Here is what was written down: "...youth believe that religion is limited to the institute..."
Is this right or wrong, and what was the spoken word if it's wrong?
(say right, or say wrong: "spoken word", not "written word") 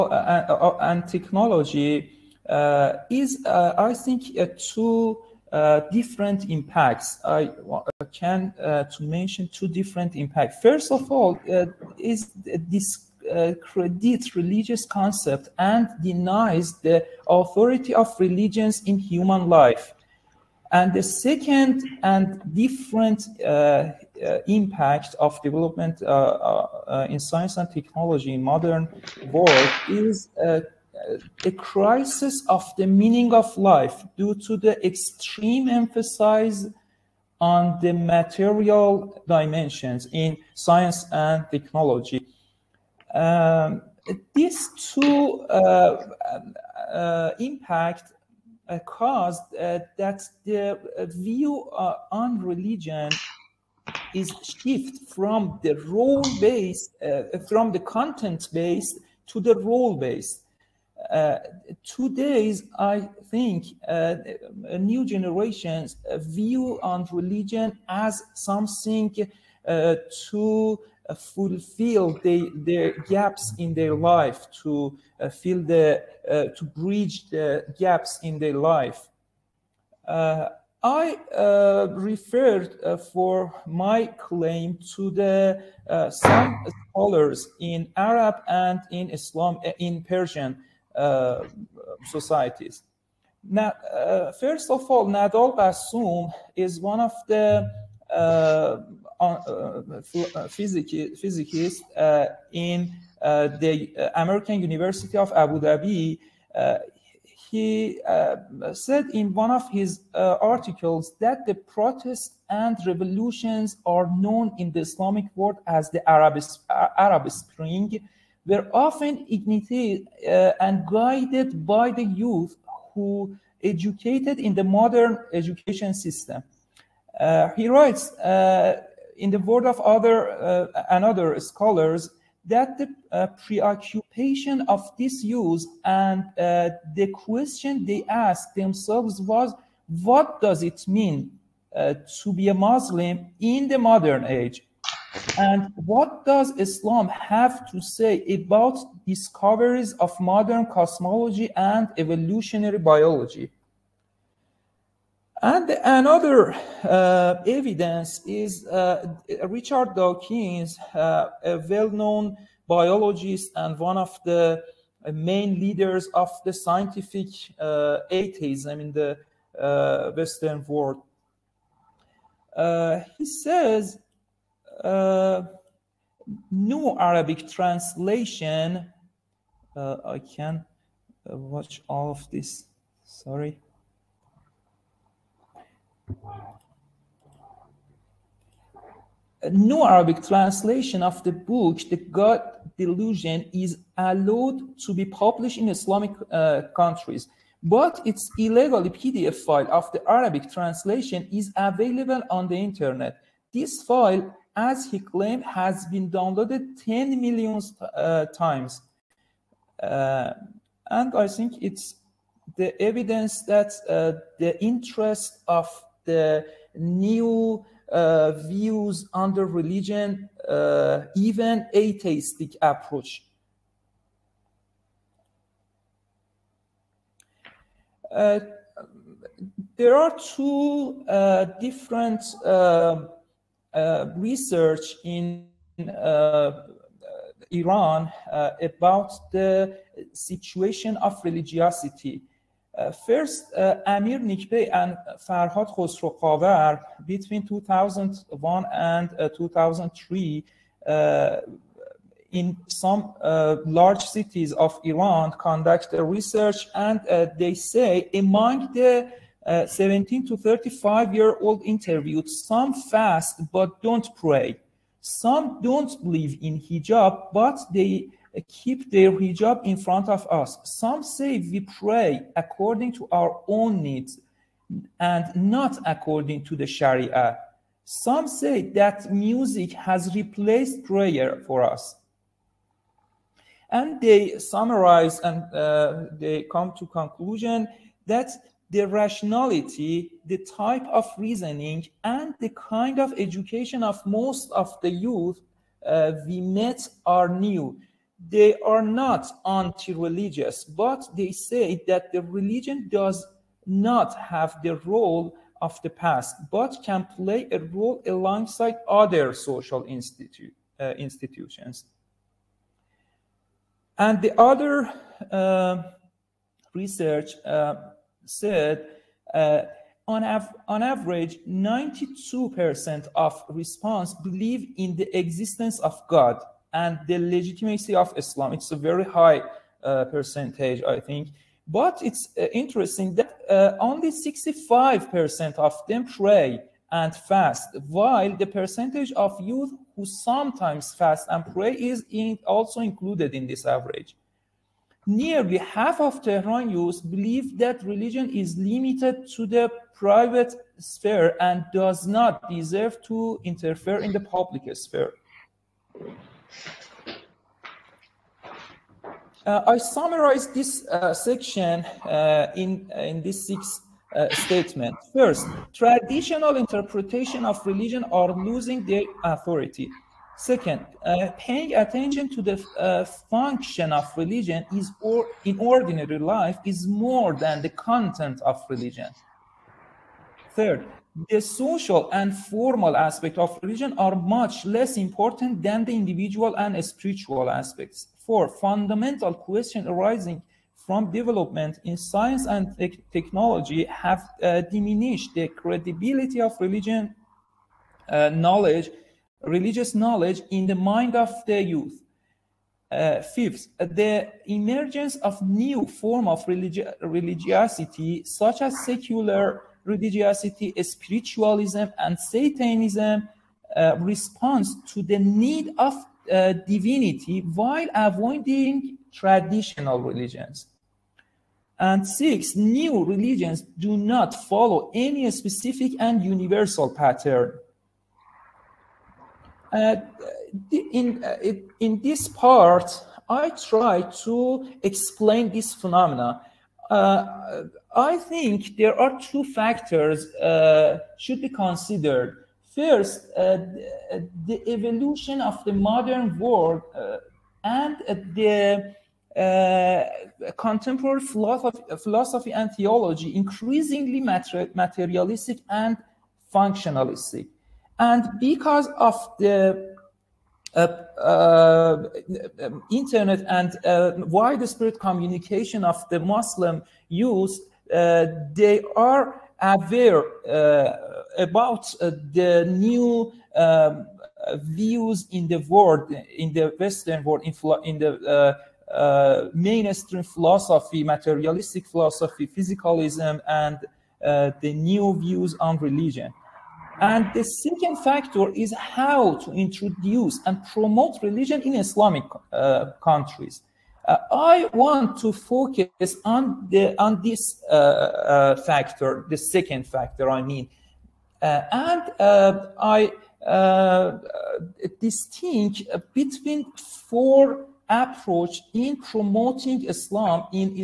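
wrong: "private", not "institute".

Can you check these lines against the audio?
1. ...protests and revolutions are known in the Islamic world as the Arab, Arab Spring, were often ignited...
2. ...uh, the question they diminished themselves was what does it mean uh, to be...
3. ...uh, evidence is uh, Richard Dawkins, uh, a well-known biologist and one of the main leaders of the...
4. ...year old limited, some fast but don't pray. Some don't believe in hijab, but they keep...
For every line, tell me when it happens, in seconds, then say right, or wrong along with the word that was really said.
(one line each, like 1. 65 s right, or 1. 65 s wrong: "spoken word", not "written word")
1. 111 s right
2. 136 s wrong: "asked", not "diminished"
3. 156 s right
4. 261 s wrong: "interviewed", not "limited".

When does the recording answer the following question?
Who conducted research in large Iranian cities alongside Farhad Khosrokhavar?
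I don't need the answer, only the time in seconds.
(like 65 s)
243 s.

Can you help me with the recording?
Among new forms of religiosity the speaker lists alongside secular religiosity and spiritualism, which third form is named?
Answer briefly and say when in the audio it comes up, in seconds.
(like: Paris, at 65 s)
Satanism, at 412 s.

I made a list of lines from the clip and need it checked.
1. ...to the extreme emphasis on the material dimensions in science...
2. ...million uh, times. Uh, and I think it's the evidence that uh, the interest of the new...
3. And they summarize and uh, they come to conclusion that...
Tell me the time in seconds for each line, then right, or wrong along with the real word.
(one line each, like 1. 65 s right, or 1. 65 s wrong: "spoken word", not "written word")
1. 34 s right
2. 207 s right
3. 283 s right.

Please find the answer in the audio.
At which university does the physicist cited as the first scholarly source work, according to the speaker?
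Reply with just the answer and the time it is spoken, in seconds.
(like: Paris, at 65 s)
American University of Abu Dhabi, at 104 s.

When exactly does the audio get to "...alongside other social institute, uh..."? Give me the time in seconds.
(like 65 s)
308 s.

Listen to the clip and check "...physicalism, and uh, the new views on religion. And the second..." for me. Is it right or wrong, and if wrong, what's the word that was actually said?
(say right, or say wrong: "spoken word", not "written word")
right.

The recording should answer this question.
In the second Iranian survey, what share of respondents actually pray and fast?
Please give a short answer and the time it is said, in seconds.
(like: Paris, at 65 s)
65%, at 334 s.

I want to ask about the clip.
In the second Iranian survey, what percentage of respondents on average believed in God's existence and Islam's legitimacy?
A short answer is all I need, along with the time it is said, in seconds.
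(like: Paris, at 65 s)
92%, at 321 s.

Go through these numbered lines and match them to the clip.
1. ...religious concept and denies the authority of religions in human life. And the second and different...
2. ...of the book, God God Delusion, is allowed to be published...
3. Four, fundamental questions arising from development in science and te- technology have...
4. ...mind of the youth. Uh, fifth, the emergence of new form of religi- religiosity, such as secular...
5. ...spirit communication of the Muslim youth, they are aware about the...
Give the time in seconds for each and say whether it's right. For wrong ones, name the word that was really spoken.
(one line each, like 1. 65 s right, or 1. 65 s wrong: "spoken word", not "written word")
1. 14 s right
2. 191 s wrong: "The", not "God"
3. 388 s right
4. 400 s right
5. 464 s right.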